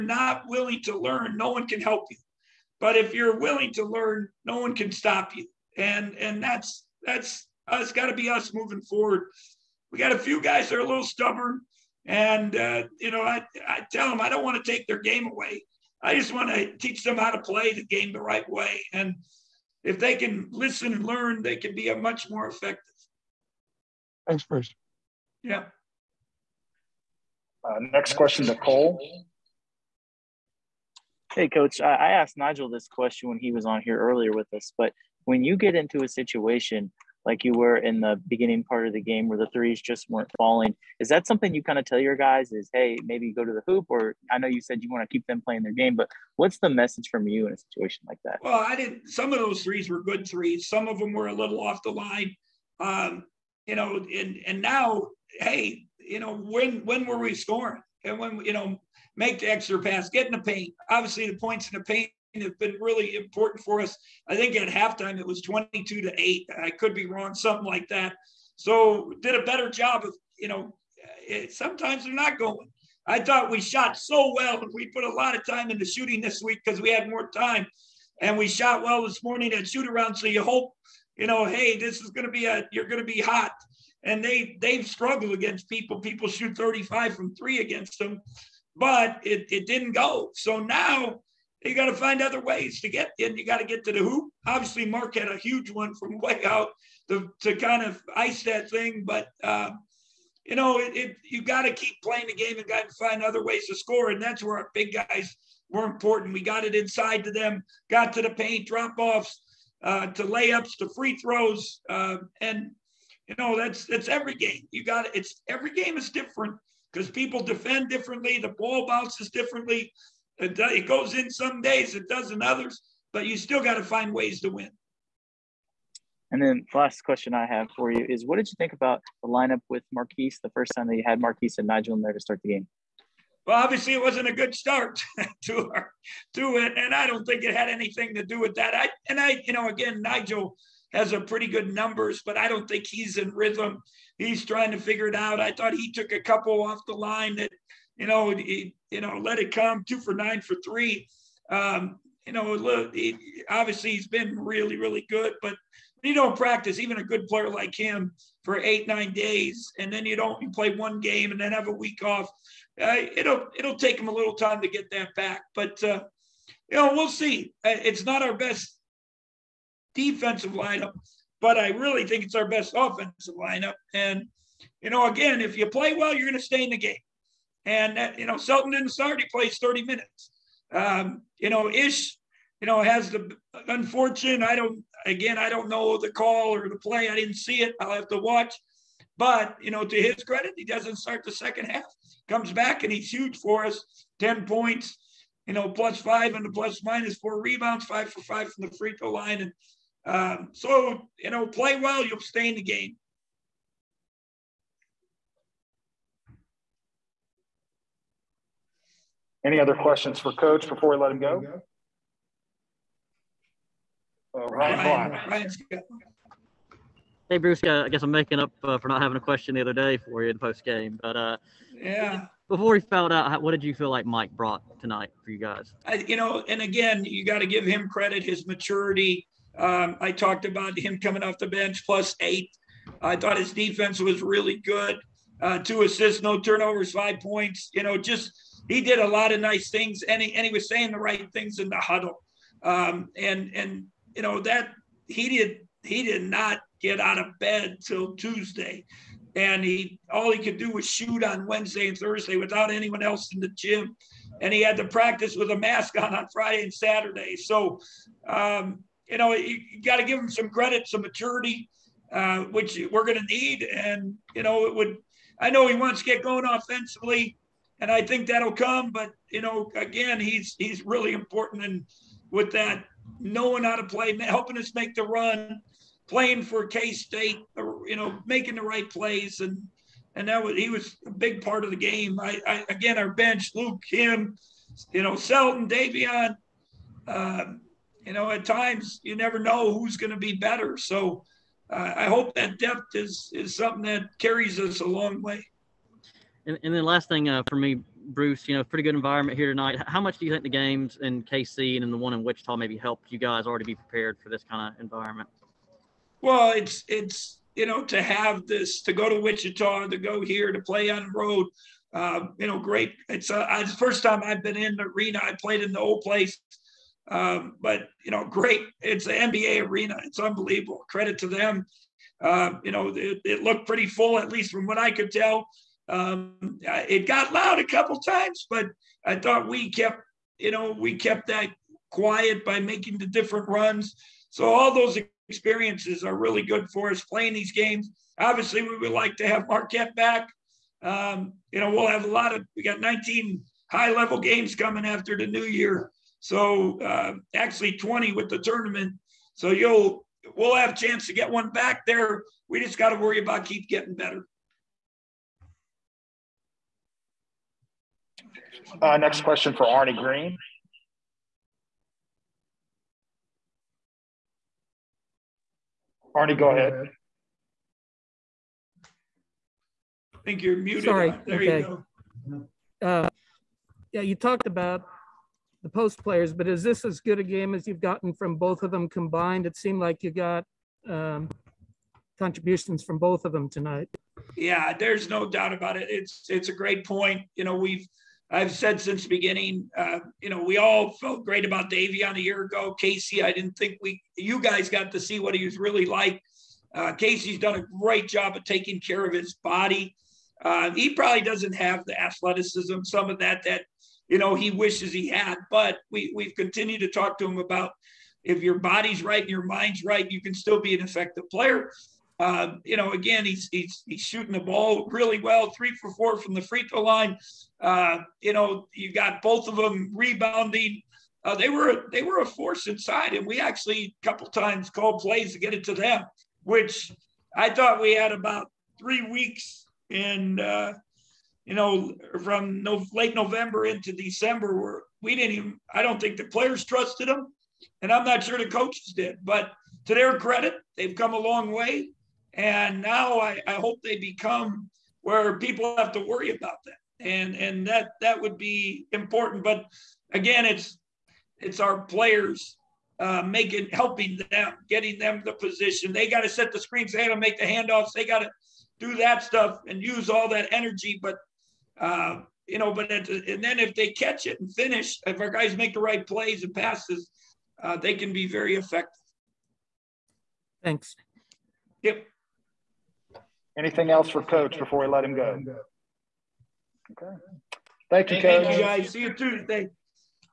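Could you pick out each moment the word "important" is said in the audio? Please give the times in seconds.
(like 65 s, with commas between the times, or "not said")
63 s, 105 s, 271 s, 448 s.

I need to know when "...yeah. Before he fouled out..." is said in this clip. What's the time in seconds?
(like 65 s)
221 s.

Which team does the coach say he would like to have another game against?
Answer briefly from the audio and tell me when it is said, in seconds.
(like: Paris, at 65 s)
Marquette, at 339 s.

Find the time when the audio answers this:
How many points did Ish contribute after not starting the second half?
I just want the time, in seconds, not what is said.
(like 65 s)
194 s.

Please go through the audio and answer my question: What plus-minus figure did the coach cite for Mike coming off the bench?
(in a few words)
+8.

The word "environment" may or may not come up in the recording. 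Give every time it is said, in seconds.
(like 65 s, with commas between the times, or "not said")
298 s, 304 s.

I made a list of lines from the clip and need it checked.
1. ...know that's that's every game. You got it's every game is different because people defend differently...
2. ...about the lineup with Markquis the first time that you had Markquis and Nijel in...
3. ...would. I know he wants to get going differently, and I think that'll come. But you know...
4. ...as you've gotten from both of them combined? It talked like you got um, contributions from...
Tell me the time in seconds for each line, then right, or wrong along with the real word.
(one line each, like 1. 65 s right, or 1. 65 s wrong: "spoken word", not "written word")
1. 113 s right
2. 128 s right
3. 264 s wrong: "offensively", not "differently"
4. 377 s wrong: "seemed", not "talked".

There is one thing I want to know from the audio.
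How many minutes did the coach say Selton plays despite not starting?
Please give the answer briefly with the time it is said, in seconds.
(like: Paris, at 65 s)
30, at 179 s.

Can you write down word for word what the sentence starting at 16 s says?
I just want to teach them how to play the game the right way.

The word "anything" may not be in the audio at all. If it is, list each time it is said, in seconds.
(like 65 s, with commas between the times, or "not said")
137 s, 473 s.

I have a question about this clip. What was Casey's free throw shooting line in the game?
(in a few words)
3 for 4.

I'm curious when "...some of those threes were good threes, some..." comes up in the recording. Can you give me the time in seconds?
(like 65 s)
49 s.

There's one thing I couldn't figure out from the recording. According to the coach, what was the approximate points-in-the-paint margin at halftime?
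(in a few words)
22 to 8.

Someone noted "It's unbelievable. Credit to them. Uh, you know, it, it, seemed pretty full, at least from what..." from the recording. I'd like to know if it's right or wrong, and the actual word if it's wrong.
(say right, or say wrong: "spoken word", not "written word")
wrong: "looked", not "seemed".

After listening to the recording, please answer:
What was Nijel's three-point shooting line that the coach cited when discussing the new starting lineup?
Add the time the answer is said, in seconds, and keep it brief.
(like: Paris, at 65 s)
2 for 9, at 149 s.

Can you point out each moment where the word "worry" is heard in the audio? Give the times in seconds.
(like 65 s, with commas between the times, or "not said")
352 s, 446 s.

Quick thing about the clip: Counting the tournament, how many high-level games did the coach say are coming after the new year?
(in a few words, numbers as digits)
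20.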